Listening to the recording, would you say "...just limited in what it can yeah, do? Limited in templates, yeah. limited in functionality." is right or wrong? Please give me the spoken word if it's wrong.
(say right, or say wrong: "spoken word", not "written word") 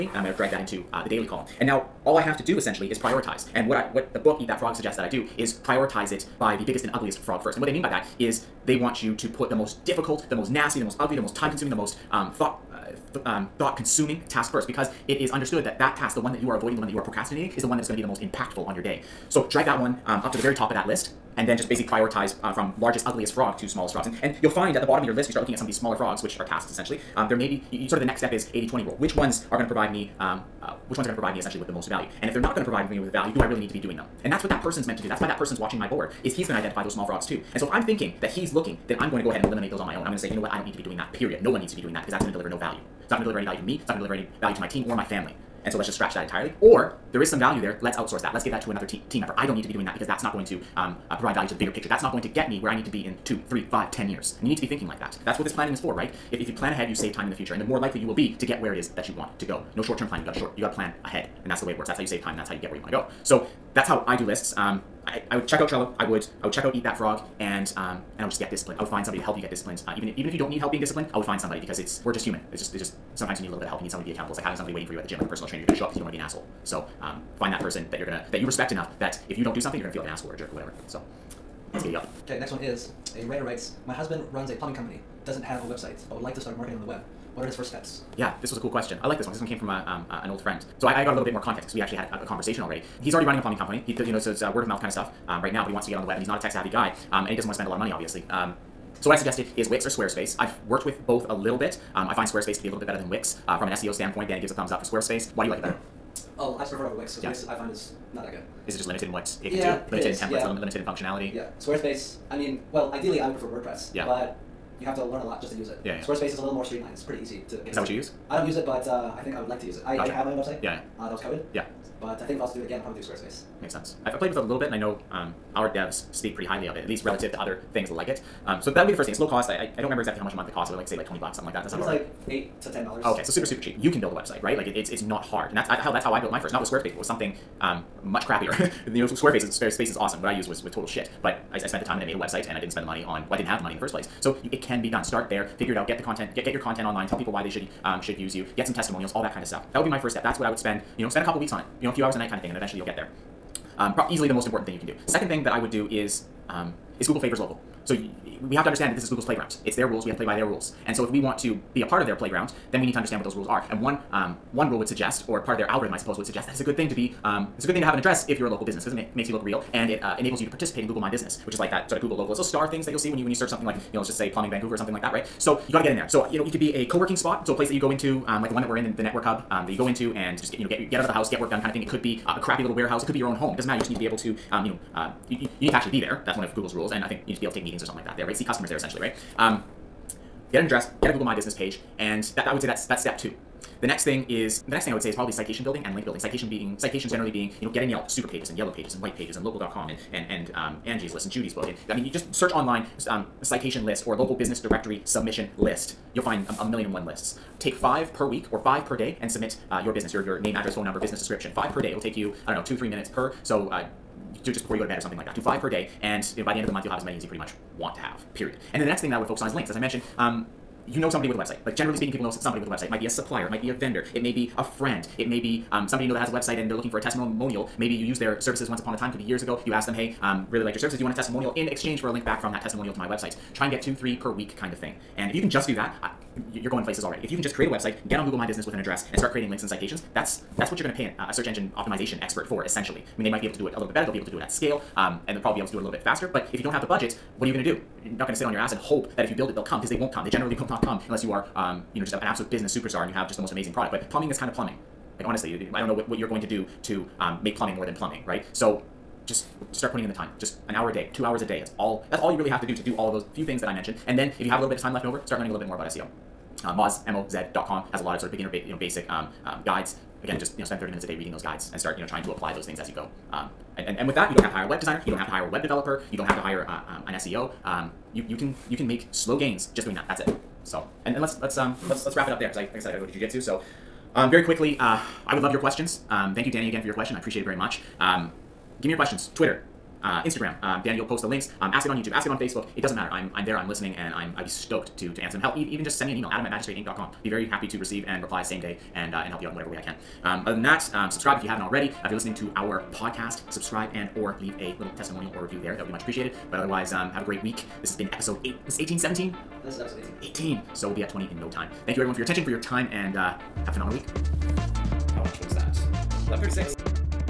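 right.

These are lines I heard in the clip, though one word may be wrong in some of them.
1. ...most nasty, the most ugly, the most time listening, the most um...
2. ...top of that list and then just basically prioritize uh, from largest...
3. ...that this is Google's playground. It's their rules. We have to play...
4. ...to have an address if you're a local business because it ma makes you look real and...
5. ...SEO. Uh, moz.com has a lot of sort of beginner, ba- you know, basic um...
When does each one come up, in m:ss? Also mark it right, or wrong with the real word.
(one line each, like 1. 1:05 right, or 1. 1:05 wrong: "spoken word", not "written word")
1. 0:10 wrong: "consuming", not "listening"
2. 0:20 right
3. 2:38 right
4. 2:47 right
5. 4:25 right.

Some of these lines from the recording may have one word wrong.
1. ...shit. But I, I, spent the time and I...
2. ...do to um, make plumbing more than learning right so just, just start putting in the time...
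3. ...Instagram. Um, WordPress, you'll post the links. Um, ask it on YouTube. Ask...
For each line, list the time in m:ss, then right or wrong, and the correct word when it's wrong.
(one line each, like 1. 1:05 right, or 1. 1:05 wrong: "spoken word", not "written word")
1. 2:20 right
2. 4:16 wrong: "plumbing", not "learning"
3. 4:50 wrong: "Danny", not "WordPress".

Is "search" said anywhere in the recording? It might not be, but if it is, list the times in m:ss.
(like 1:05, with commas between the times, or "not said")
2:53, 3:22, 4:01.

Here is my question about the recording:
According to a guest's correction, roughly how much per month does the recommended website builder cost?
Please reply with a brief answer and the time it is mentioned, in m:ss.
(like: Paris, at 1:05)
8 to 10 dollars, at 2:12.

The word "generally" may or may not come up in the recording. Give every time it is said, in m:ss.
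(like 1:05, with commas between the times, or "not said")
3:17, 3:41, 4:10.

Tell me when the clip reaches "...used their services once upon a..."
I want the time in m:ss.
3:48.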